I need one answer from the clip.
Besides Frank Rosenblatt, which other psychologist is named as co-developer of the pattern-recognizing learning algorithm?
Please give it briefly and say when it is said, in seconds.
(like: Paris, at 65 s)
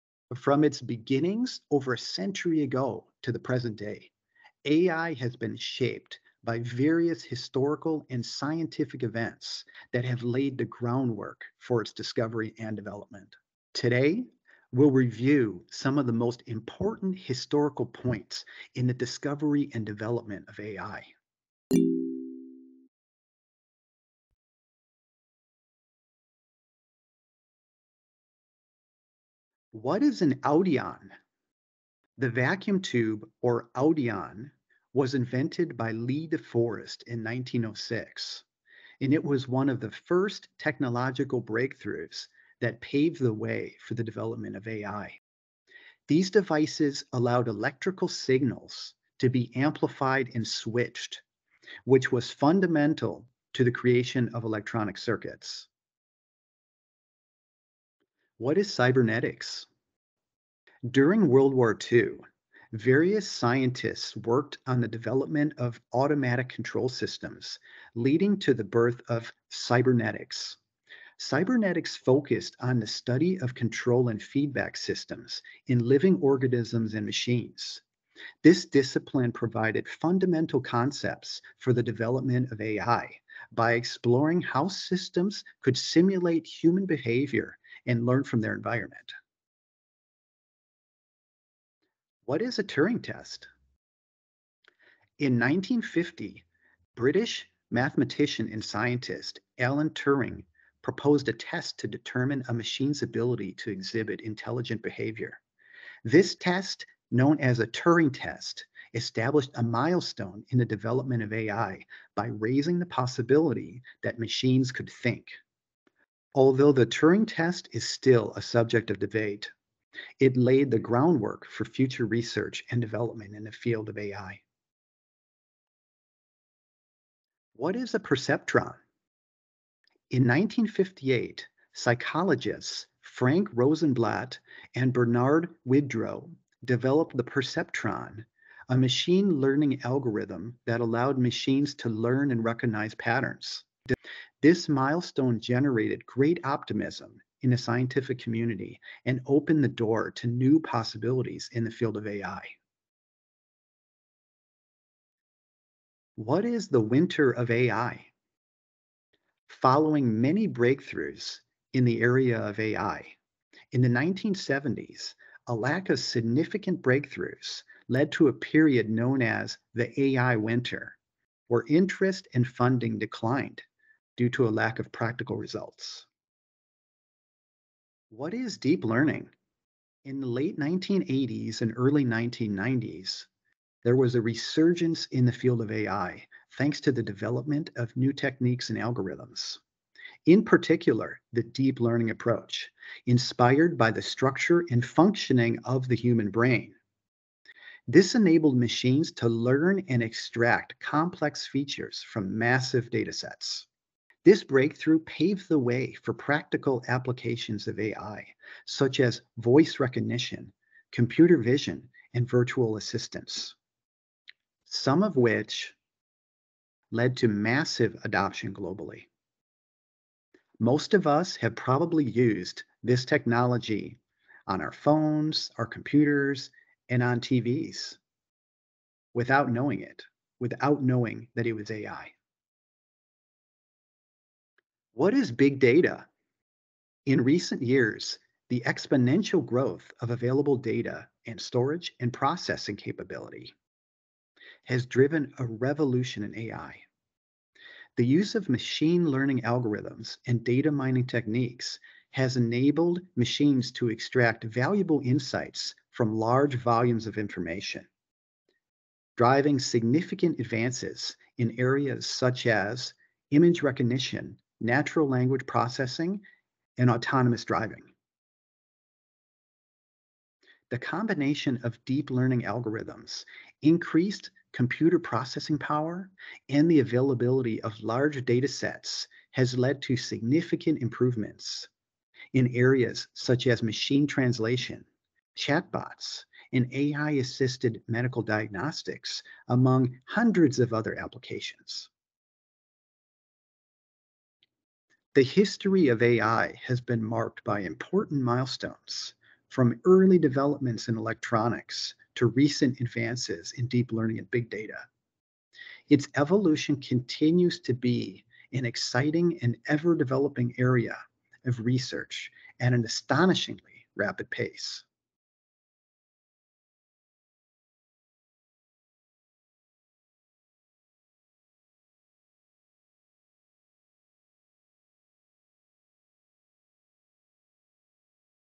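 Bernard Widrow, at 134 s.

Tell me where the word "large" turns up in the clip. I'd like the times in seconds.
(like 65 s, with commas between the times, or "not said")
256 s, 277 s.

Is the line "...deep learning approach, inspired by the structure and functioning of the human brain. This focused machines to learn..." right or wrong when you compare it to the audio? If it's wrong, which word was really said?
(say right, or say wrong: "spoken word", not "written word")
wrong: "enabled", not "focused".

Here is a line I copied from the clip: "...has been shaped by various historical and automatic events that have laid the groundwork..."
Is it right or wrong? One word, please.
wrong.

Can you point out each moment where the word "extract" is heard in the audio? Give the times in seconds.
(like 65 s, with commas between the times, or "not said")
200 s, 253 s.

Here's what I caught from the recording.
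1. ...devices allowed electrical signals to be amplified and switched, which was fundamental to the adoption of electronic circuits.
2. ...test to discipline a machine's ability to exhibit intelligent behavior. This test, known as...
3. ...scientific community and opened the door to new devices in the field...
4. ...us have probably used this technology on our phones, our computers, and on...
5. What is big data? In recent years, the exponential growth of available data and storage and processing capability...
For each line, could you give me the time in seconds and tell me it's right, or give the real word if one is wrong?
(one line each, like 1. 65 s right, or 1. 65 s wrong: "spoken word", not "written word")
1. 46 s wrong: "creation", not "adoption"
2. 101 s wrong: "determine", not "discipline"
3. 147 s wrong: "possibilities", not "devices"
4. 221 s right
5. 234 s right.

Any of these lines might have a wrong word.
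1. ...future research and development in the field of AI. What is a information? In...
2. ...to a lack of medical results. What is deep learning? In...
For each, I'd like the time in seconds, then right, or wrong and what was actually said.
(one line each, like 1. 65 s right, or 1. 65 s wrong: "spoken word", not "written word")
1. 121 s wrong: "perceptron", not "information"
2. 174 s wrong: "practical", not "medical".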